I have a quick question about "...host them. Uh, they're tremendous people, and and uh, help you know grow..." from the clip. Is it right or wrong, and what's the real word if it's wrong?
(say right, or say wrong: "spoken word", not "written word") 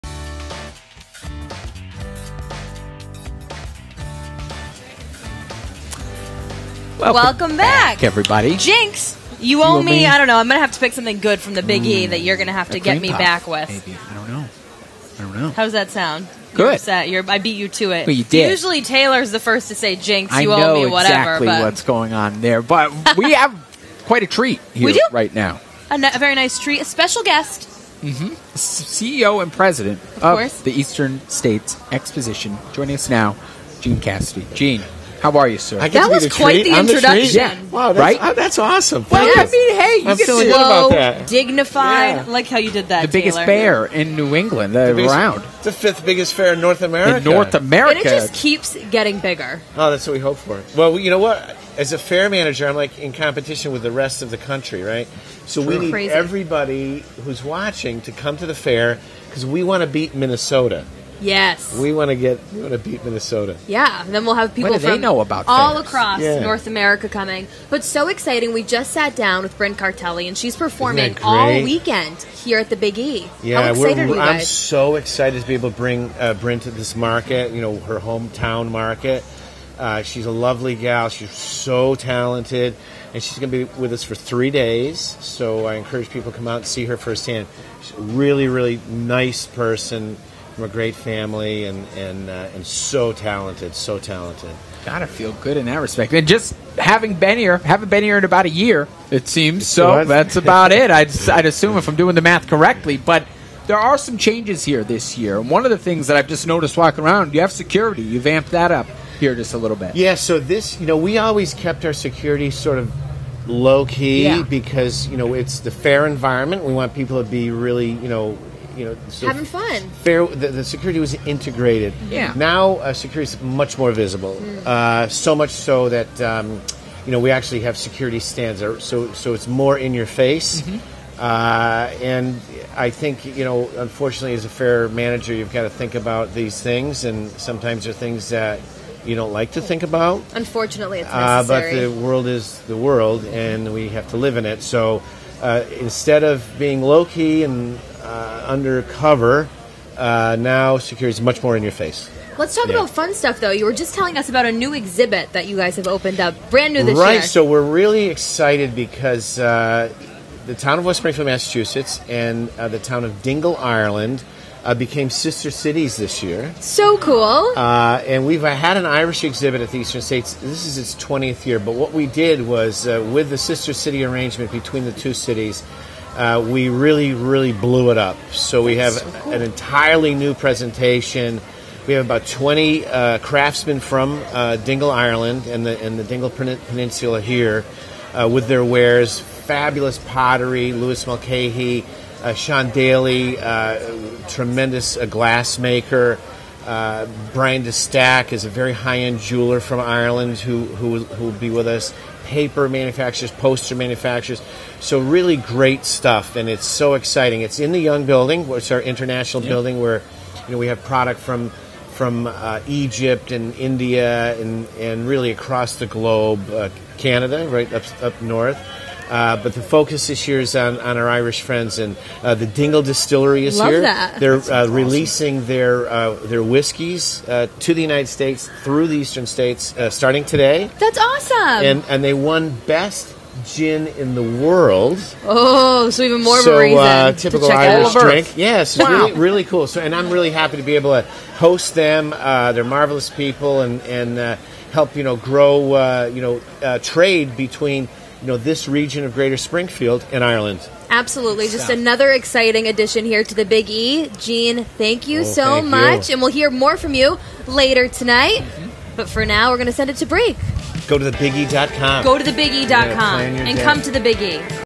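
wrong: "marvelous", not "tremendous".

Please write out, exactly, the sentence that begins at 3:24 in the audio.
So really great stuff, and it's so exciting.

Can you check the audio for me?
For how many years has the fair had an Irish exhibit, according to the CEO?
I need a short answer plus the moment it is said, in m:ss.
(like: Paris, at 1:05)
20, at 2:51.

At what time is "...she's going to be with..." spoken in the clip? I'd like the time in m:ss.
1:23.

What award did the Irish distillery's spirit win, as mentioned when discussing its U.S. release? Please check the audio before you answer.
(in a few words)
Best gin in the world.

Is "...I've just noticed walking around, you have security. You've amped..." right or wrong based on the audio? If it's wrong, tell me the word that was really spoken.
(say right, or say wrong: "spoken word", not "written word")
right.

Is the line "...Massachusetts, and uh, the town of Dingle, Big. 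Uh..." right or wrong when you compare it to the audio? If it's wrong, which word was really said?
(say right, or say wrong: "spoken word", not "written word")
wrong: "Ireland", not "Big".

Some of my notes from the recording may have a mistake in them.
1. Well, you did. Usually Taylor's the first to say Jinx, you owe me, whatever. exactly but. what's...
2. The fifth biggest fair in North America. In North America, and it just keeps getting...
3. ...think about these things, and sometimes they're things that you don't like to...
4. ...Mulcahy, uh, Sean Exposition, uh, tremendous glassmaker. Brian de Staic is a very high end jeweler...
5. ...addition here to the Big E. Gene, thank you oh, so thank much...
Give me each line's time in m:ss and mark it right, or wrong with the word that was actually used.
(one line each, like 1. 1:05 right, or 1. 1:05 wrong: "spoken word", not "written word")
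1. 0:18 right
2. 0:45 right
3. 2:15 right
4. 3:11 wrong: "Daly", not "Exposition"
5. 4:12 right.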